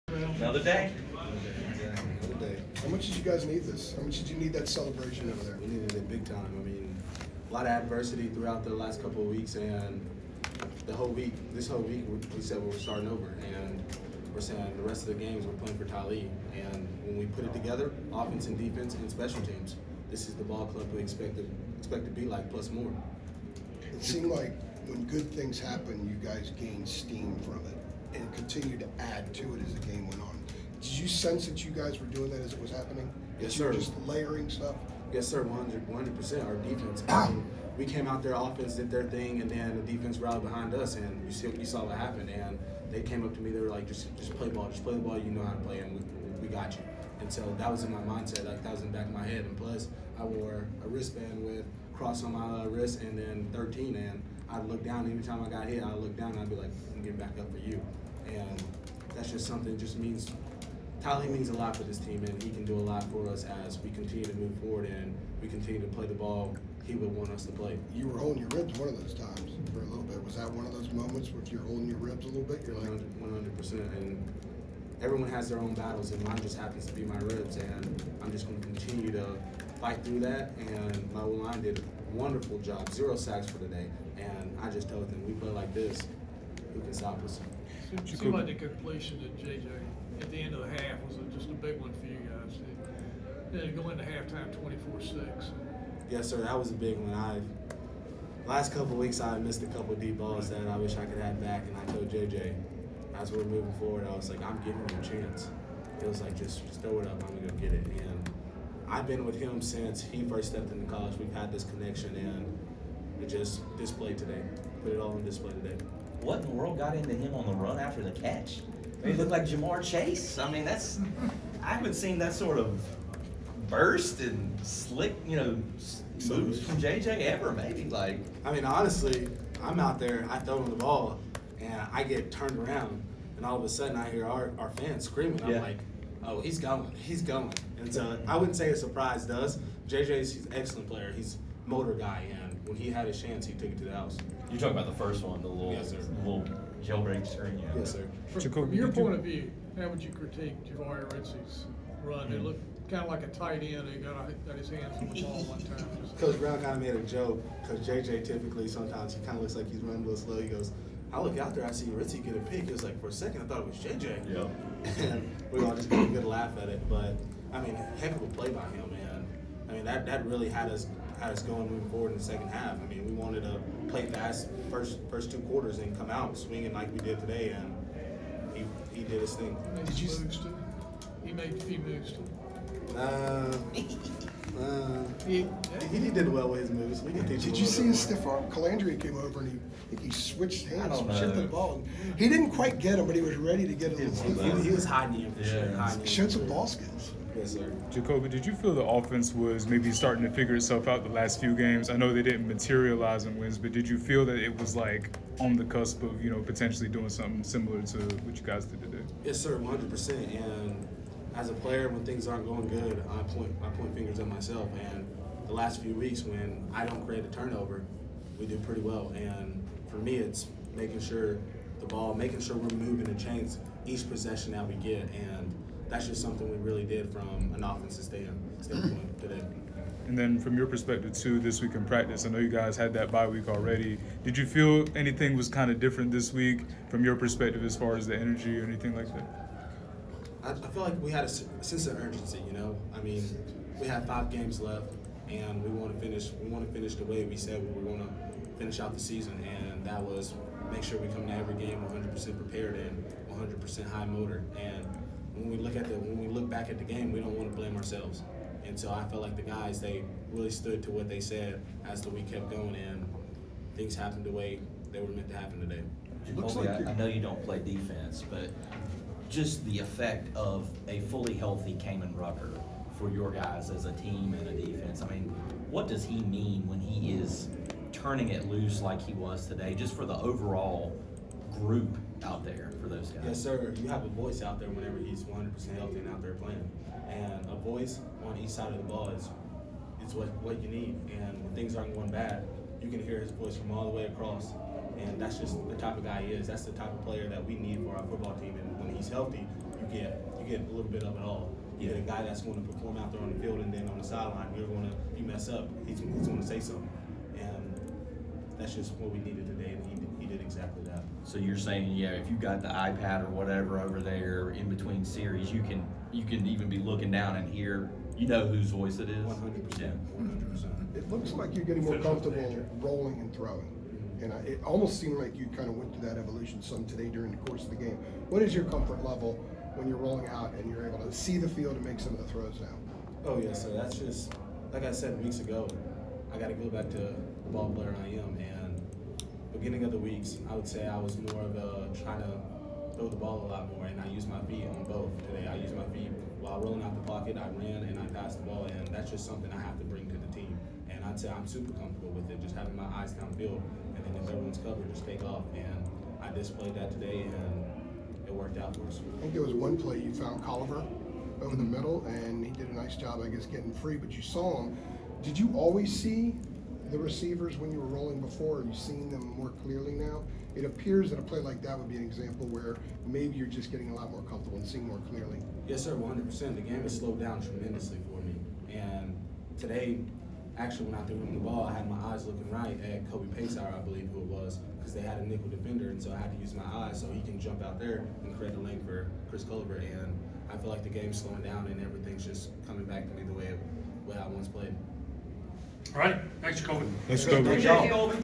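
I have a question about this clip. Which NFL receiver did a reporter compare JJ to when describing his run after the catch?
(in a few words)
Ja'Marr Chase.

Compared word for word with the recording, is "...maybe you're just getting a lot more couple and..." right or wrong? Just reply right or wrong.
wrong.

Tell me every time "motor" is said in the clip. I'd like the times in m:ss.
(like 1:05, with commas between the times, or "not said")
2:21, 4:14.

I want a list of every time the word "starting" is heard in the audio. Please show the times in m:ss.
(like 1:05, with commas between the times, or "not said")
0:12, 3:19.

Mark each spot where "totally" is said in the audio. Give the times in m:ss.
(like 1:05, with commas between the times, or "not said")
not said.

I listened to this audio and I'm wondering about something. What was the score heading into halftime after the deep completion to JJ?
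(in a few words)
24-6.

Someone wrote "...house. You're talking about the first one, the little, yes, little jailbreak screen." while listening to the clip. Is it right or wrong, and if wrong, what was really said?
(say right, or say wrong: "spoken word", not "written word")
right.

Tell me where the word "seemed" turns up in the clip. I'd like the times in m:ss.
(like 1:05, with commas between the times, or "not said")
0:24, 1:28, 5:25.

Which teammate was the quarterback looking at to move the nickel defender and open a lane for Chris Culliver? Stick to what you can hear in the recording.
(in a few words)
Kobe Paysour.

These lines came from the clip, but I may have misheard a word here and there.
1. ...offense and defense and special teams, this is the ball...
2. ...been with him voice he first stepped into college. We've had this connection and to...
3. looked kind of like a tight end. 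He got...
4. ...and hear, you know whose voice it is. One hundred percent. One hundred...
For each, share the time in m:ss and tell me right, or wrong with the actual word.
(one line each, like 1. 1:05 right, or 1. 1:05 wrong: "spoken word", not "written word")
1. 0:18 right
2. 1:49 wrong: "since", not "voice"
3. 2:32 right
4. 5:17 right.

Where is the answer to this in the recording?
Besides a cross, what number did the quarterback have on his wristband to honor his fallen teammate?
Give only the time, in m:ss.
0:53.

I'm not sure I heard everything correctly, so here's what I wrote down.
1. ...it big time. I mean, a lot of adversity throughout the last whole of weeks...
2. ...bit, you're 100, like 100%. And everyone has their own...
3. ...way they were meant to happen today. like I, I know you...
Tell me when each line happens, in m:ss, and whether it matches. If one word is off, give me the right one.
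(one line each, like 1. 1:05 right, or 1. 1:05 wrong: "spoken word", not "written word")
1. 0:05 wrong: "couple", not "whole"
2. 1:12 right
3. 4:24 right.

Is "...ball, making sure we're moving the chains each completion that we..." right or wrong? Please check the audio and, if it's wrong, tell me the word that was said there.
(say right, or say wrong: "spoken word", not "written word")
wrong: "possession", not "completion".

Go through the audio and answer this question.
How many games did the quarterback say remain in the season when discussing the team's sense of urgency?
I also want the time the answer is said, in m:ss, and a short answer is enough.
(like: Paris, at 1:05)
5, at 4:04.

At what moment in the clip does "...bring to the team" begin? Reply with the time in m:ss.
5:49.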